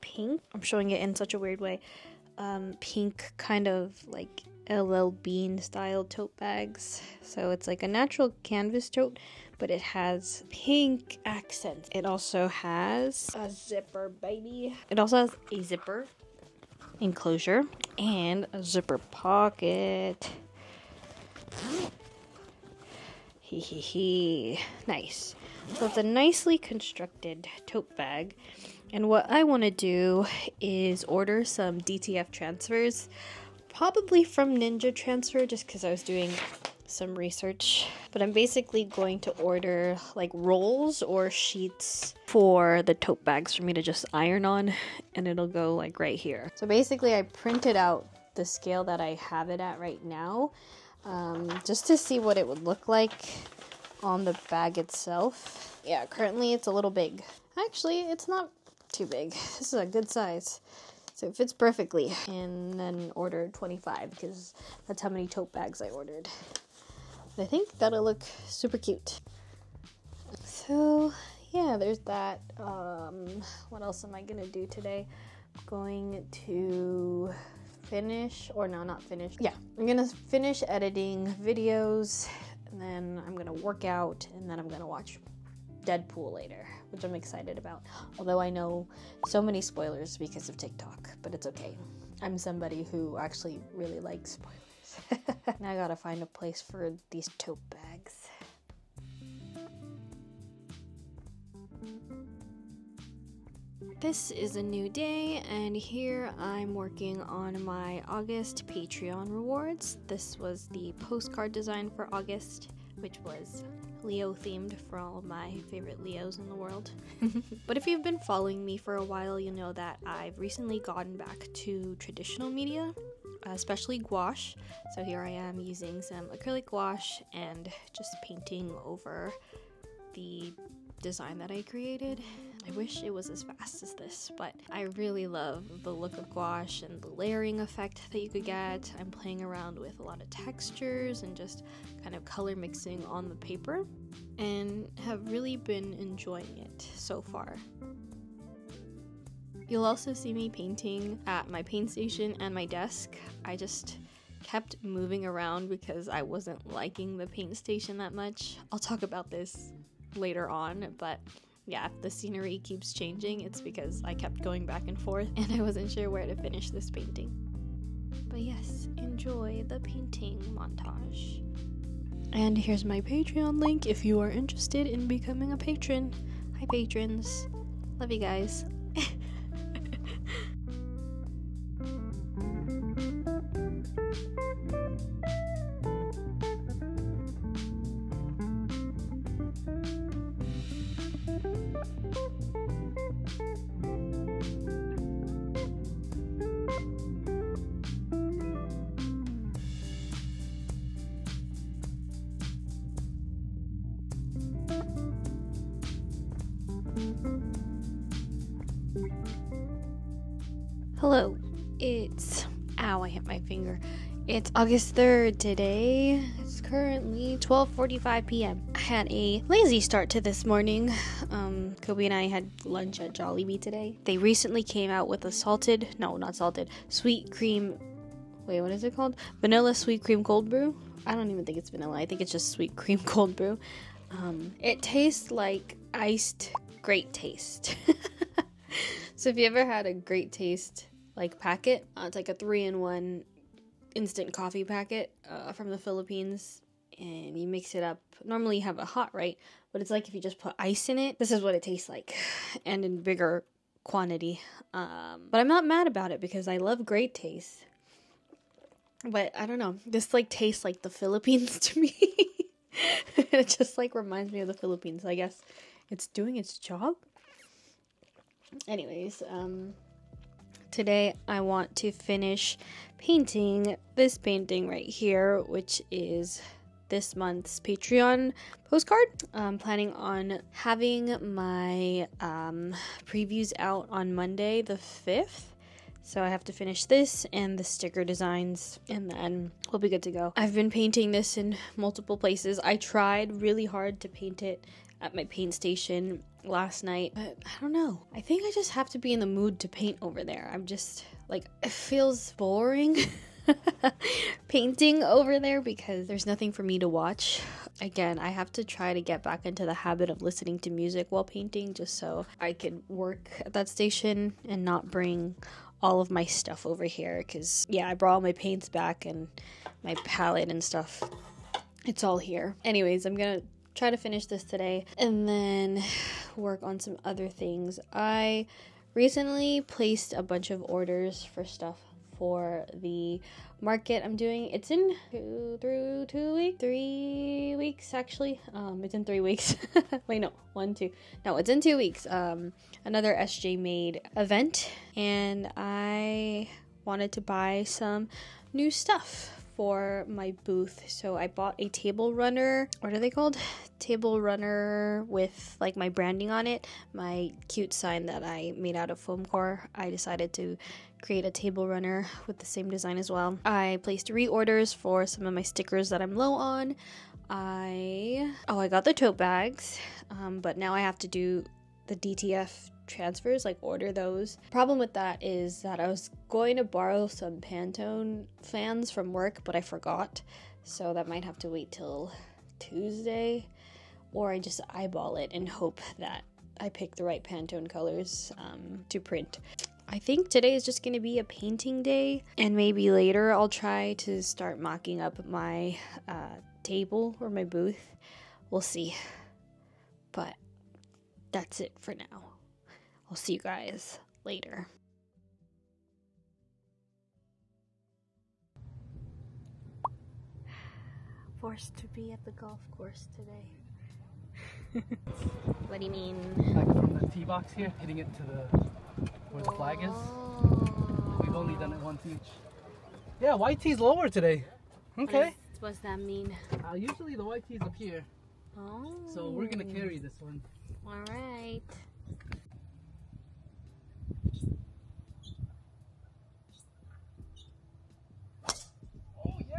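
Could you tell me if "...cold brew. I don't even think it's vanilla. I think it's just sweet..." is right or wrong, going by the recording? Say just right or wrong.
right.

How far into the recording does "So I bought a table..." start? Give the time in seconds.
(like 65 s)
350 s.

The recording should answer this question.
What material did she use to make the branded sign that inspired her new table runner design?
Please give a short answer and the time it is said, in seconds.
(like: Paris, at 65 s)
foam core, at 359 s.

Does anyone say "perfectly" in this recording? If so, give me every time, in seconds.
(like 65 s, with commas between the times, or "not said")
61 s.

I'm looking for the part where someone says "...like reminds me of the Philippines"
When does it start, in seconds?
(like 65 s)
263 s.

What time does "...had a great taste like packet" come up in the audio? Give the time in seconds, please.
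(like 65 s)
239 s.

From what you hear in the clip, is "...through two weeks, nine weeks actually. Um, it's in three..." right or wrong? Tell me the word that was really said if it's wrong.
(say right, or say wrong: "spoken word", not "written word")
wrong: "three", not "nine".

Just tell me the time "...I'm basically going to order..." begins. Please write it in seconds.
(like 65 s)
38 s.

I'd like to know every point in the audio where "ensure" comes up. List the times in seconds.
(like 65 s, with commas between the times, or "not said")
not said.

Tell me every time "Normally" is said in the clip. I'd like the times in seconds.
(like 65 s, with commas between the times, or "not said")
248 s.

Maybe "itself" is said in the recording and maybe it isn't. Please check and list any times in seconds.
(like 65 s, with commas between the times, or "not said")
54 s.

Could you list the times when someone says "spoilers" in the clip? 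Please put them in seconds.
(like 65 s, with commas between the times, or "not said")
89 s, 94 s.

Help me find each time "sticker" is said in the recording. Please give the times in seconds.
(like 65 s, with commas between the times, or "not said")
287 s, 365 s.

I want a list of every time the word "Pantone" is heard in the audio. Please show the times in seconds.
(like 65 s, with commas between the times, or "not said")
377 s, 387 s.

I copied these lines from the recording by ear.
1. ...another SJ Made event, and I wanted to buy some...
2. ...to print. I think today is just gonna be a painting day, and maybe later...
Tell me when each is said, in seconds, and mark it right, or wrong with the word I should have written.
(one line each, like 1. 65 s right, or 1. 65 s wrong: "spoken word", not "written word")
1. 342 s right
2. 388 s right.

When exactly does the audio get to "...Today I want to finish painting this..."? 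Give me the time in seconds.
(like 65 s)
270 s.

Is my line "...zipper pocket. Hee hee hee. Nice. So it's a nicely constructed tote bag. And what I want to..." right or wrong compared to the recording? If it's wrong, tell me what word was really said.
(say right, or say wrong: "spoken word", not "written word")
right.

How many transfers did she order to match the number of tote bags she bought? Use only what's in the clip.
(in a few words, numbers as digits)
25.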